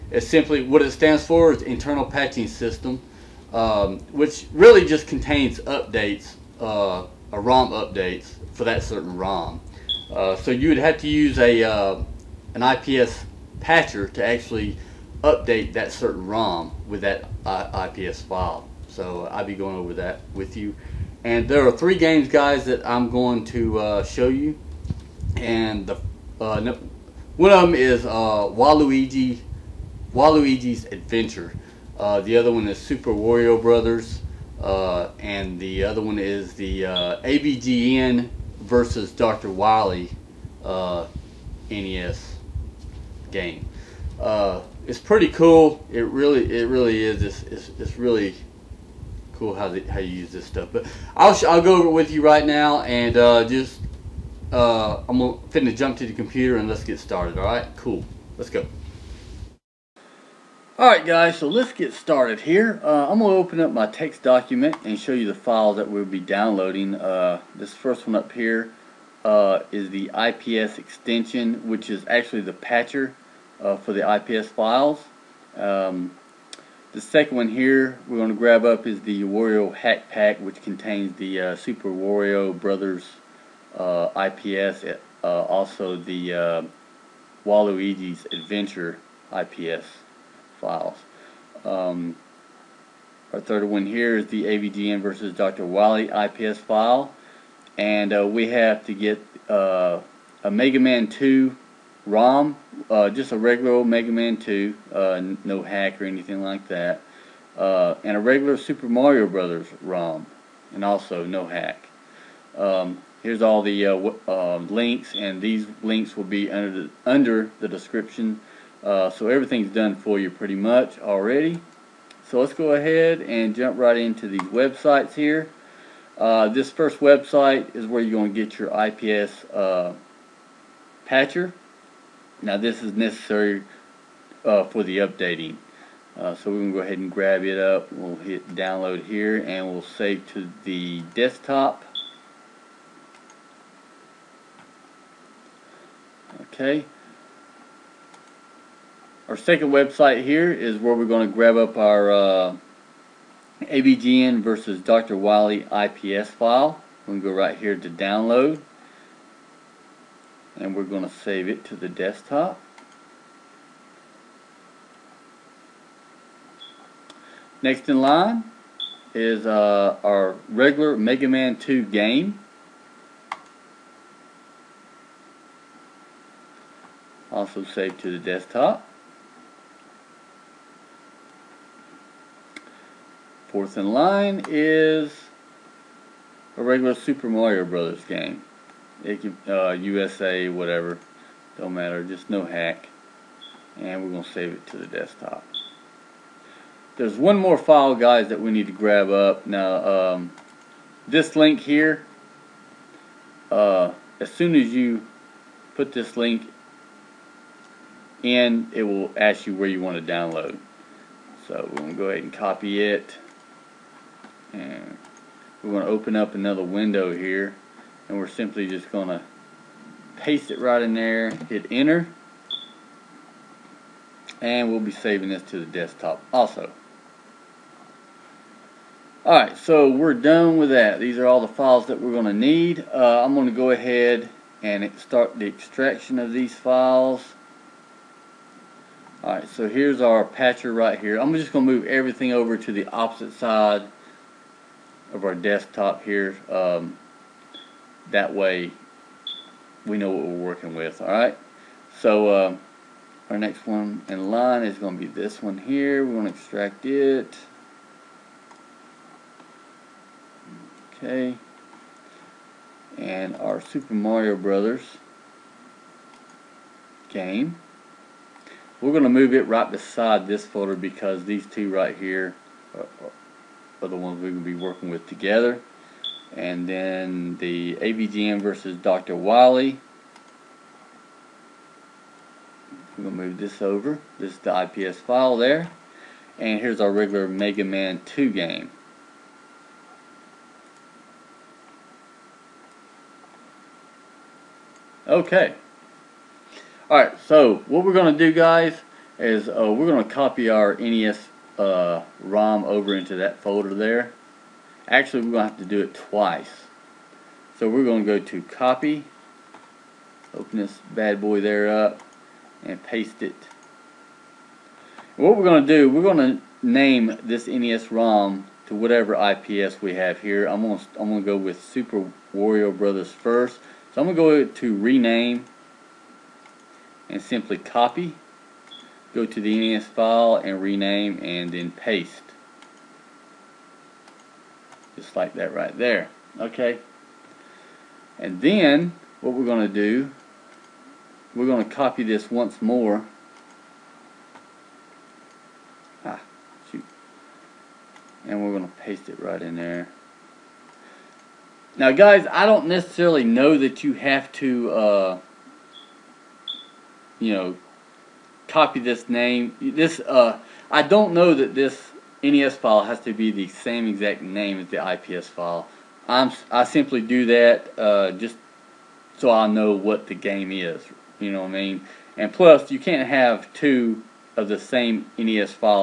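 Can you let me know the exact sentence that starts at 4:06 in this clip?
Um, that way we know what we're working with.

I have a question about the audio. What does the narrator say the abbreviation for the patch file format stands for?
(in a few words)
Internal Patching System.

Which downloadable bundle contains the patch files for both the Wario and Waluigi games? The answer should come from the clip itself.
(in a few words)
Wario Hack Pack.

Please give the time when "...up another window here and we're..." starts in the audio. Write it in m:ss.
3:36.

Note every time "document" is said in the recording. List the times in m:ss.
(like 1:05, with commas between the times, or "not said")
1:04.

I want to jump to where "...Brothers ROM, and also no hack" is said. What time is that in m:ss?
1:49.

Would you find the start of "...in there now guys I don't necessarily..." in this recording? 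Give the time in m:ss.
5:49.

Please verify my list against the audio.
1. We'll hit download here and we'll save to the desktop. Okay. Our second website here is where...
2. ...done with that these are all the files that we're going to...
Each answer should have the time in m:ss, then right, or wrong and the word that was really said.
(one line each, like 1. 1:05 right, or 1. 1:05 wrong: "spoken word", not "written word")
1. 2:17 right
2. 3:50 right.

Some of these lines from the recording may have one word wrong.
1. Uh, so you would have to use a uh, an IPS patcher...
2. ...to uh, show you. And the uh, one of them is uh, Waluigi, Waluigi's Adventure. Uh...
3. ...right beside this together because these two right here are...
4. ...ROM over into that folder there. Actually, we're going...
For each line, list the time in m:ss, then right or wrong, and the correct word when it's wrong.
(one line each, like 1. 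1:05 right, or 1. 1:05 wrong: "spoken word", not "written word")
1. 0:10 right
2. 0:23 right
3. 4:29 wrong: "folder", not "together"
4. 5:02 right.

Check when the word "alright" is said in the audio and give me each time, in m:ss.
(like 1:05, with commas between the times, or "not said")
1:00, 3:49, 3:59, 4:56.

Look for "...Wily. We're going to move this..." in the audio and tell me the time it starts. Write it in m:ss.
4:39.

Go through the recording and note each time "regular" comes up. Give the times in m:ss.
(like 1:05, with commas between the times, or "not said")
1:43, 1:48, 2:50, 3:06, 4:46.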